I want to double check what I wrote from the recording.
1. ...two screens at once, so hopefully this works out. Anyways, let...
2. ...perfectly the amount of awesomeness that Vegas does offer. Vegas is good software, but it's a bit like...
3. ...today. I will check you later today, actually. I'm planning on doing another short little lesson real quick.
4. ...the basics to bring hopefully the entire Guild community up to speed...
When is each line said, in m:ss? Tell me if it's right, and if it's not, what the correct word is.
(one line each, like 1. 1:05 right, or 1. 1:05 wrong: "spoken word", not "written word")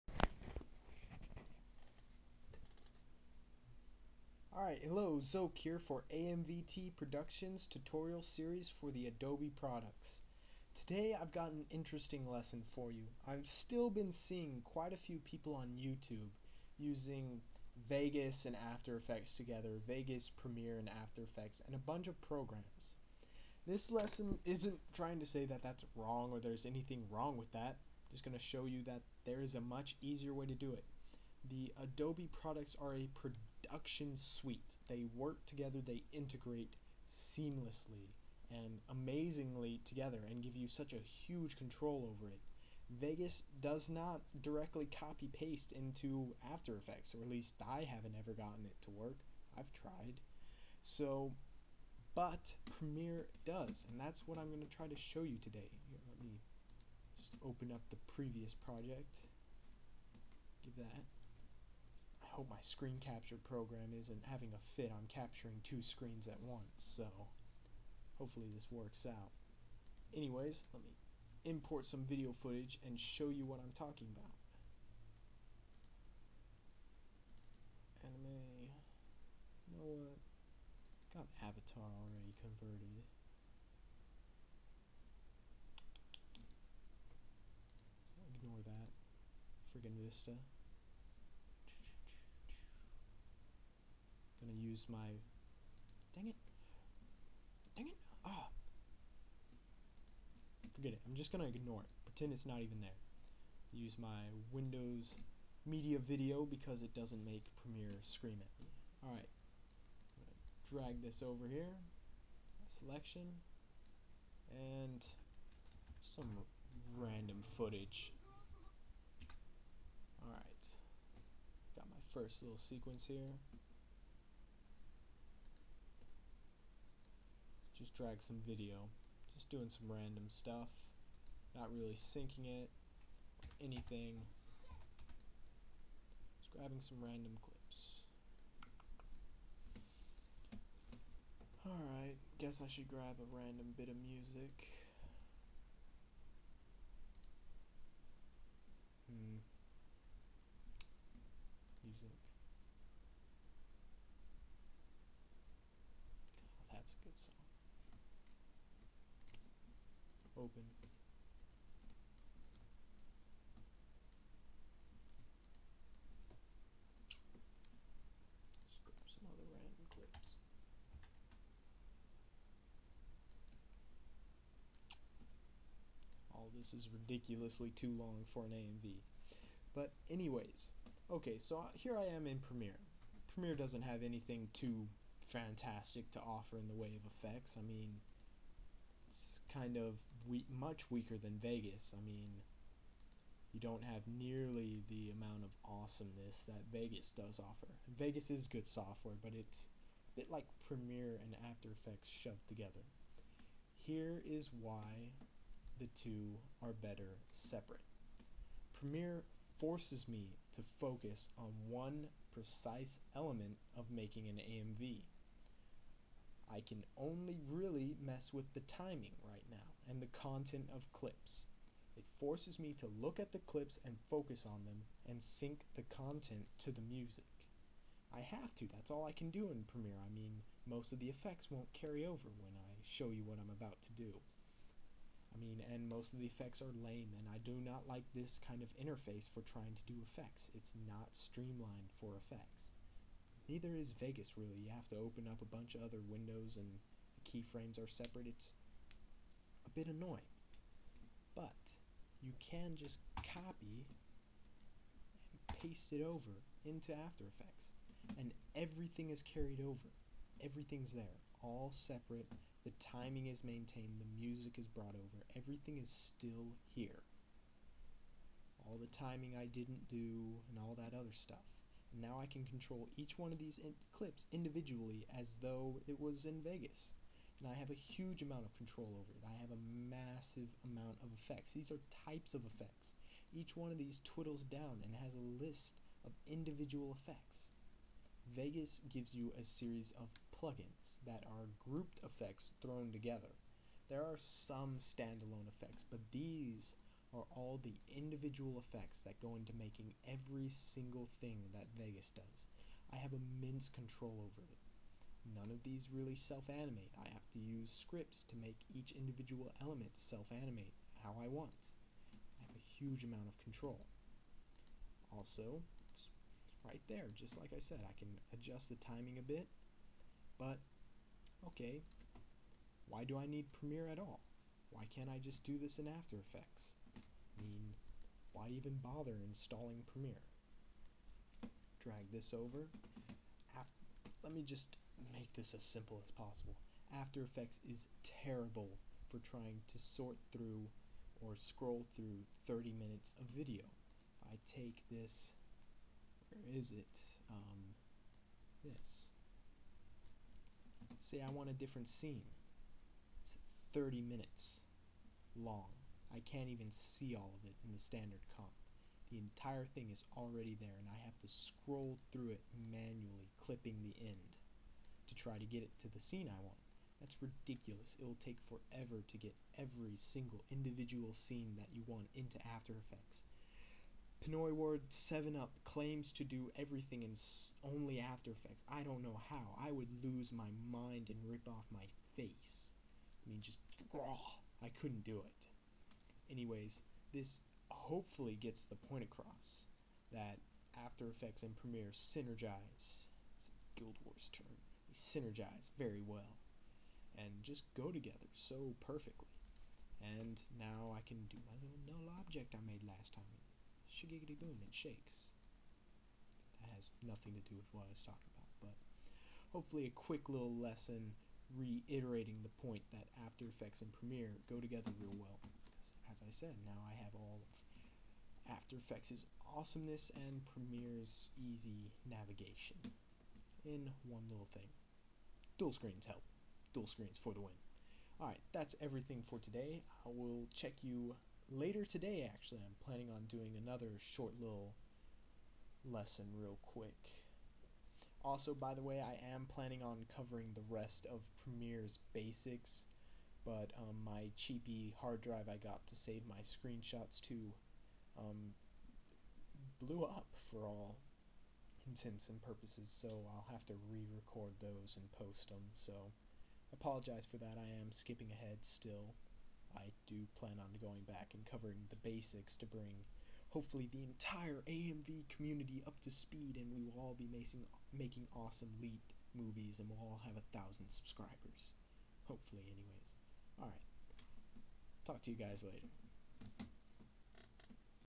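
1. 1:05 right
2. 3:14 wrong: "nearly", not "perfectly"
3. 7:09 right
4. 7:41 wrong: "AMV", not "Guild".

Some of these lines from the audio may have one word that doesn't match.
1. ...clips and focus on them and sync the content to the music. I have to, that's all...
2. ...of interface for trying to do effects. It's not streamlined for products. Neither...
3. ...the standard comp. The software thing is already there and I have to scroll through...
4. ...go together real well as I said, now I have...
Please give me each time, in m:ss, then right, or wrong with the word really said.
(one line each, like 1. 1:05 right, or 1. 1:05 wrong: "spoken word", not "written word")
1. 3:43 right
2. 3:58 wrong: "effects", not "products"
3. 5:57 wrong: "entire", not "software"
4. 6:54 right.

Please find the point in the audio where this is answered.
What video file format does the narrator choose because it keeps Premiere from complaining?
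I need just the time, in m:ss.
1:44.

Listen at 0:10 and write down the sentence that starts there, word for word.
Today I've got an interesting lesson for you.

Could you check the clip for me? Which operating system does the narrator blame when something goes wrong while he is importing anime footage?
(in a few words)
Vista.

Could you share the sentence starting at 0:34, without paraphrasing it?
They work together, they integrate seamlessly and amazingly together and give you such a huge control over it.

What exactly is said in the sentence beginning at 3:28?
Premiere forces me to focus on one precise element of making an AMV.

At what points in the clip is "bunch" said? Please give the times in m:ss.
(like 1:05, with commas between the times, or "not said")
0:21, 4:05.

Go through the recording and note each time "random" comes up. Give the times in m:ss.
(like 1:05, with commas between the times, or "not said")
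1:56, 2:09, 2:17, 2:23.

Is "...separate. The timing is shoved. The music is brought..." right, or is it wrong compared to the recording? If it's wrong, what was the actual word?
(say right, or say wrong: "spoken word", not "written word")
wrong: "maintained", not "shoved".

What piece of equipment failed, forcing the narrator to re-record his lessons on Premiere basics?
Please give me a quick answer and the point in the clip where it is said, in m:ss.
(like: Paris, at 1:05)
hard drive, at 7:25.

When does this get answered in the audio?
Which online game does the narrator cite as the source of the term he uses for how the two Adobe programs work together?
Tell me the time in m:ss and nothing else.
6:33.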